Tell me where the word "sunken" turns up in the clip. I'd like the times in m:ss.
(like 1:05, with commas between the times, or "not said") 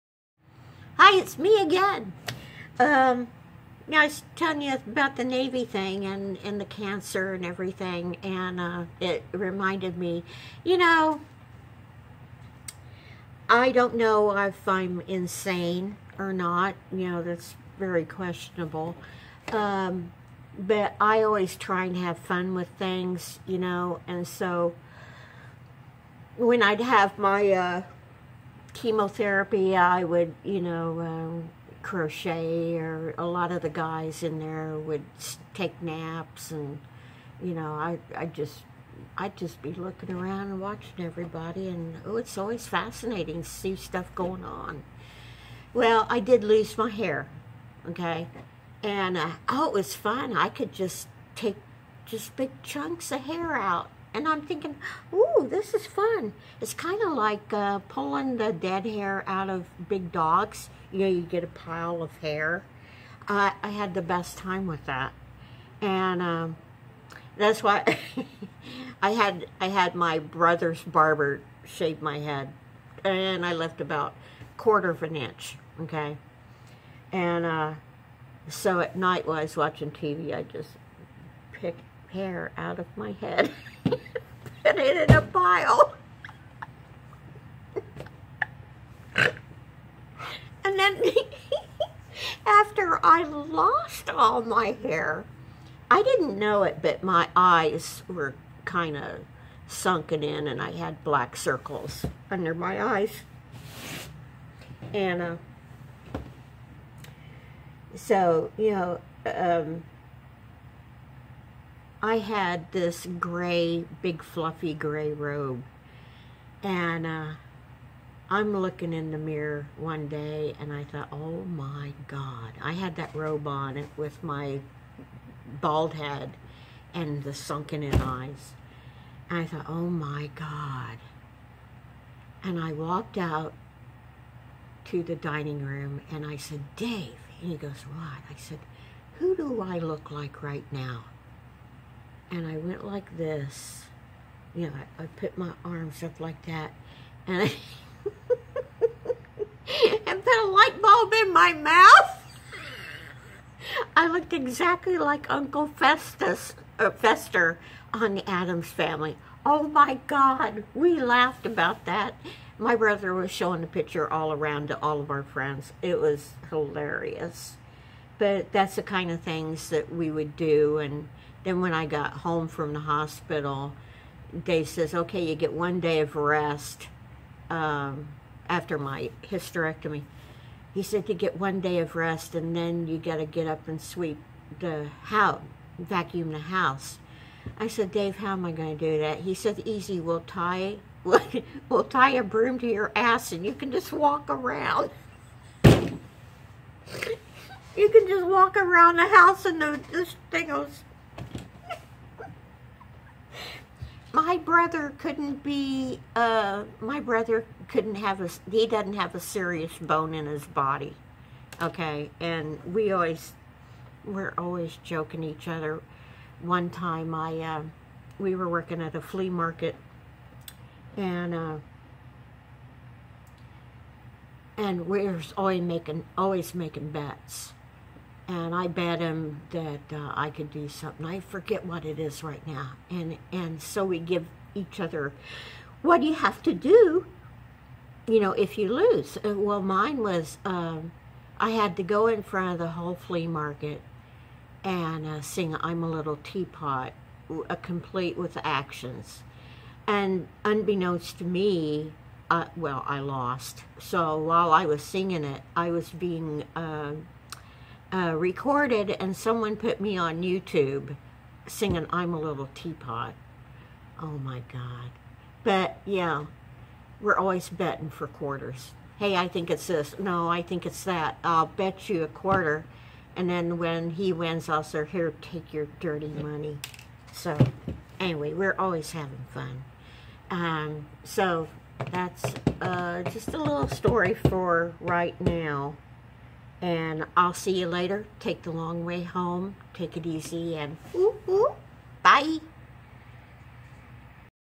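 1:39, 2:07.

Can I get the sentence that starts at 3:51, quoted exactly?
I forget what it is right now.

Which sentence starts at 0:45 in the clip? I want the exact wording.
Well, I did lose my hair, okay, and uh, oh, it was fun.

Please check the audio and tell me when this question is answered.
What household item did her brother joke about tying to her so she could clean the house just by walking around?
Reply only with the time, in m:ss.
3:12.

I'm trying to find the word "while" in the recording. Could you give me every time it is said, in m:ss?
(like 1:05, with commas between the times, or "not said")
1:19, 4:14.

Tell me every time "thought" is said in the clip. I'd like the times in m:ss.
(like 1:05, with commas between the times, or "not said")
2:00, 2:09.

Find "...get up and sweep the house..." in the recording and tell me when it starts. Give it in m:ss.
3:03.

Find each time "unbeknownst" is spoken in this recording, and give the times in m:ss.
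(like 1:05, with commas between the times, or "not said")
4:10.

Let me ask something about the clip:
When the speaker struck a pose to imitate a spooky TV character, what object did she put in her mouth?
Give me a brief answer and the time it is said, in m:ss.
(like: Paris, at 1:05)
light bulb, at 2:30.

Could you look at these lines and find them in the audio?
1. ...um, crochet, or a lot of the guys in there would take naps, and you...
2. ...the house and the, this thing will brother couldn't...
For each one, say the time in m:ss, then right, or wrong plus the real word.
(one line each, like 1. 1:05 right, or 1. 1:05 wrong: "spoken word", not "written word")
1. 0:31 right
2. 3:18 right.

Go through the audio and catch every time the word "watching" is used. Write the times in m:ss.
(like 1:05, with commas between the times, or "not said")
0:40, 1:19.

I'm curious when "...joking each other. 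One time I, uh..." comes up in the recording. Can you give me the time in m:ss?
3:34.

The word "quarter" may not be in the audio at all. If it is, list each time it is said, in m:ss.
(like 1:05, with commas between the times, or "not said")
1:14, 4:28, 4:32.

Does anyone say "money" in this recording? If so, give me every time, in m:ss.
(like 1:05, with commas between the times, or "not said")
4:36.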